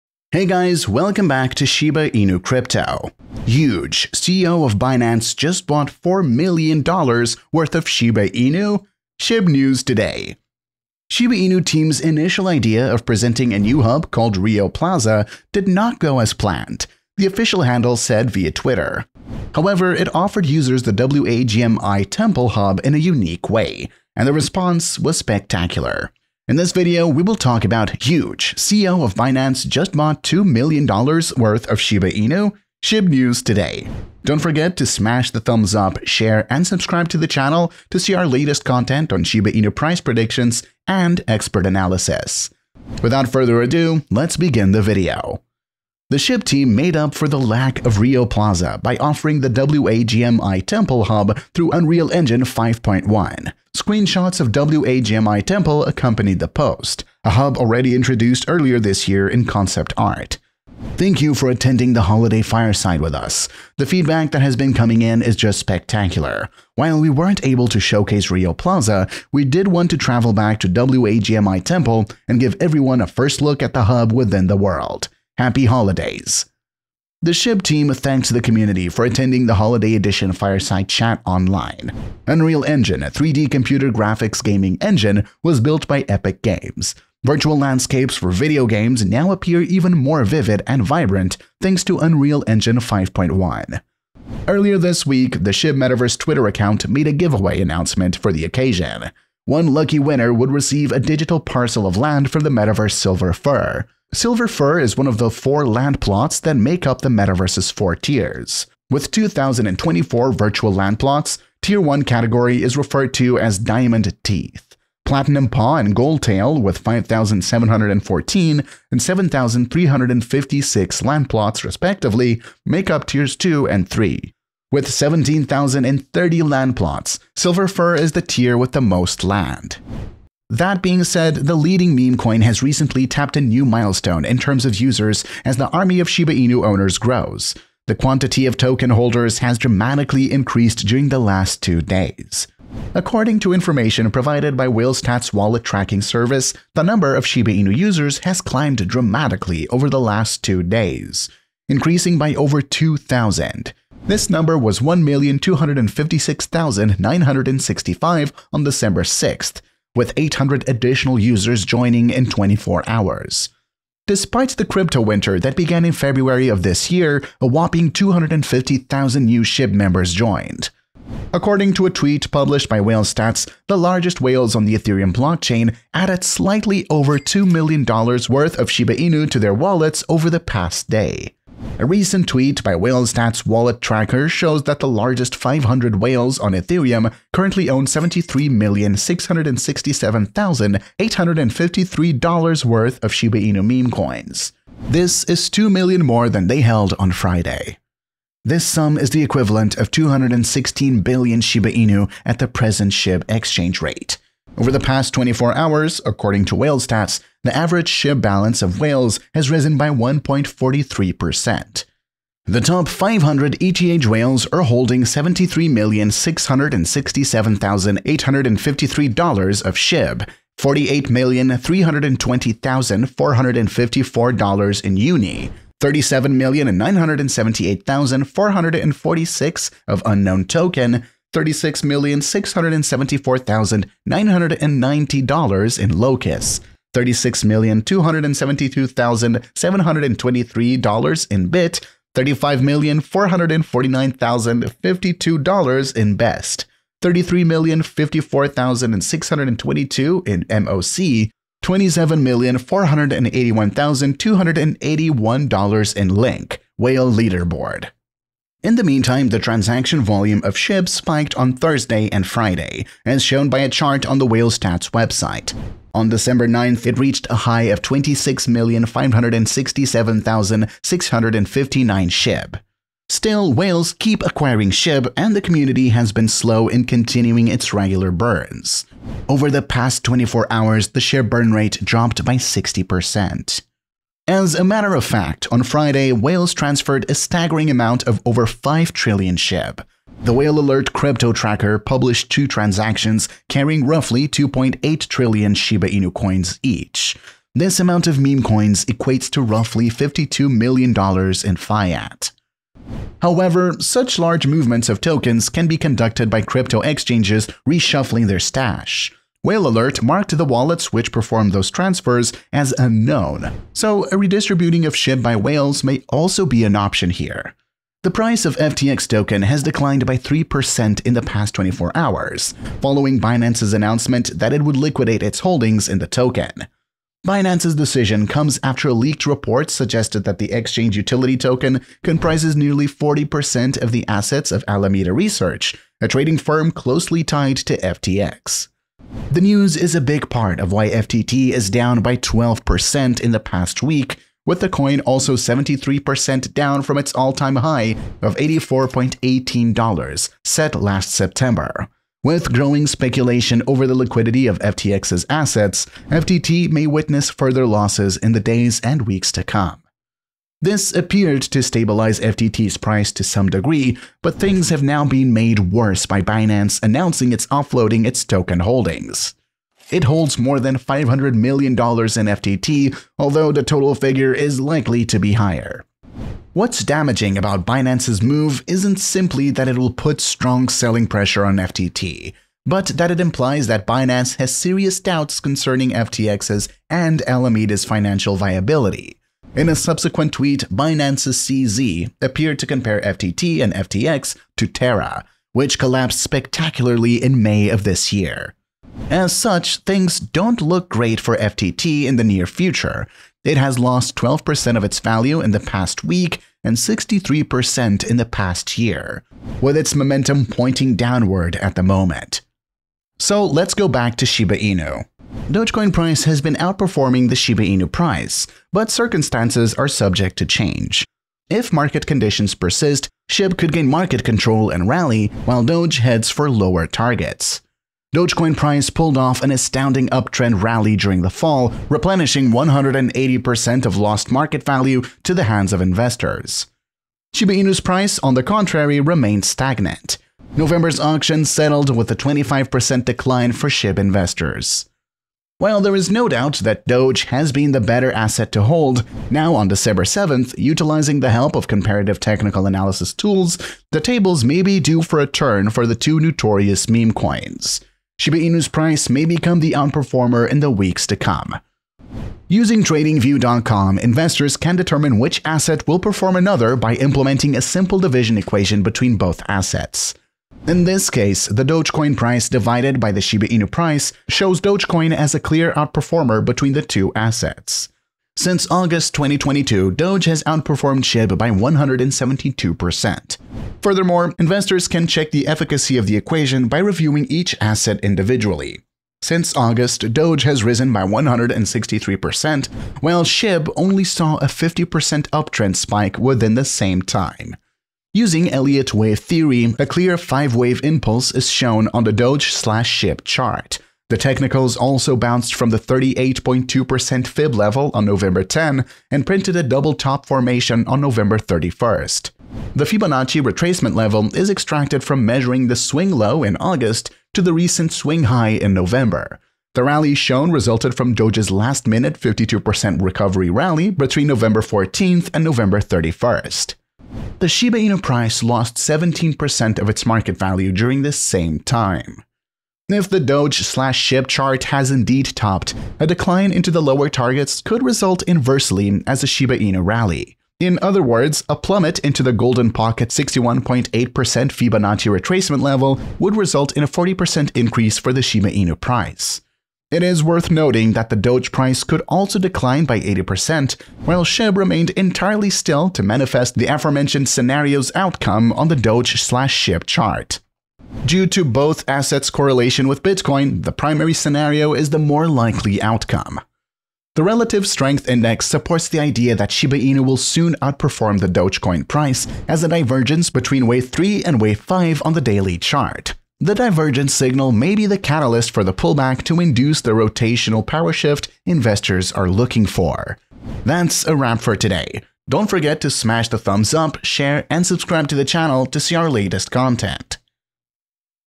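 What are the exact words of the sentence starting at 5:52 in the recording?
With growing speculation over the liquidity of FTX's assets, FTT may witness further losses in the days and weeks to come.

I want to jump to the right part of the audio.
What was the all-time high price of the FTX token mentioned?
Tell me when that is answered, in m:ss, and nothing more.
5:48.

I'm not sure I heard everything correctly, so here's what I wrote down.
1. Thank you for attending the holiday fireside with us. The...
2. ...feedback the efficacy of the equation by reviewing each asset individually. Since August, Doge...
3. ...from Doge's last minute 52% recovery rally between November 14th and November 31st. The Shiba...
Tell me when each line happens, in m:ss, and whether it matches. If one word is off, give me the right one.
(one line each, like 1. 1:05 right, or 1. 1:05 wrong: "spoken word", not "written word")
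1. 1:00 right
2. 8:05 wrong: "check", not "feedback"
3. 8:40 right.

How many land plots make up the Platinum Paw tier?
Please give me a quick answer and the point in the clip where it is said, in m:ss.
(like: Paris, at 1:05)
5,714, at 1:56.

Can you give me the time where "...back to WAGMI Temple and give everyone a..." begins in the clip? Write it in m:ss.
1:10.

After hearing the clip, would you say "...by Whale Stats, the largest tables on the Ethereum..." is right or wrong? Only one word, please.
wrong.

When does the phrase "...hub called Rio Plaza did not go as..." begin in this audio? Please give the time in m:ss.
0:13.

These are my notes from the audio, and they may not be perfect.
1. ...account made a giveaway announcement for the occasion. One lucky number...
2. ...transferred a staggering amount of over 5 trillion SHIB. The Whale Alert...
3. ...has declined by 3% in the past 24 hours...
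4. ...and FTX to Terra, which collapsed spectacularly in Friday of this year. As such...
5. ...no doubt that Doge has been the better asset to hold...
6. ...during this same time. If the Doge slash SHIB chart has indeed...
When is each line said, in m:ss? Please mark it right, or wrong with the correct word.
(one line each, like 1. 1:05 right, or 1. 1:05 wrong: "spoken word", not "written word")
1. 1:36 wrong: "winner", not "number"
2. 4:46 right
3. 5:19 right
4. 6:33 wrong: "May", not "Friday"
5. 7:26 right
6. 8:50 right.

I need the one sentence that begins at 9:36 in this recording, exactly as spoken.
The divergence signal may be the catalyst for the pullback to induce the rotational power shift investors are looking for.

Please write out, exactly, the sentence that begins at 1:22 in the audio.
Unreal Engine, a 3D computer graphics gaming engine, was built by Epic Games.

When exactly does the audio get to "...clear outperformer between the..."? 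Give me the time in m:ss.
7:55.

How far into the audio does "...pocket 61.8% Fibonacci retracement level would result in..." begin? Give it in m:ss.
9:02.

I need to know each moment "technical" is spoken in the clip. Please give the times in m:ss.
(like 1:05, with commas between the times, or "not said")
7:32, 8:24.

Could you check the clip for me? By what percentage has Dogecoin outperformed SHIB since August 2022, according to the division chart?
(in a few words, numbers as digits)
172%.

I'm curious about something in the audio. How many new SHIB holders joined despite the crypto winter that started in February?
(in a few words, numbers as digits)
250,000.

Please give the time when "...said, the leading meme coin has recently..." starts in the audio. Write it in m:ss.
2:11.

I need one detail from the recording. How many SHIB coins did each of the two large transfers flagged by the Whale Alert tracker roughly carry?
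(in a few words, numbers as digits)
2.8 trillion.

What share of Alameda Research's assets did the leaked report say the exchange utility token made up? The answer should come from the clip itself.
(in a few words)
nearly 40%.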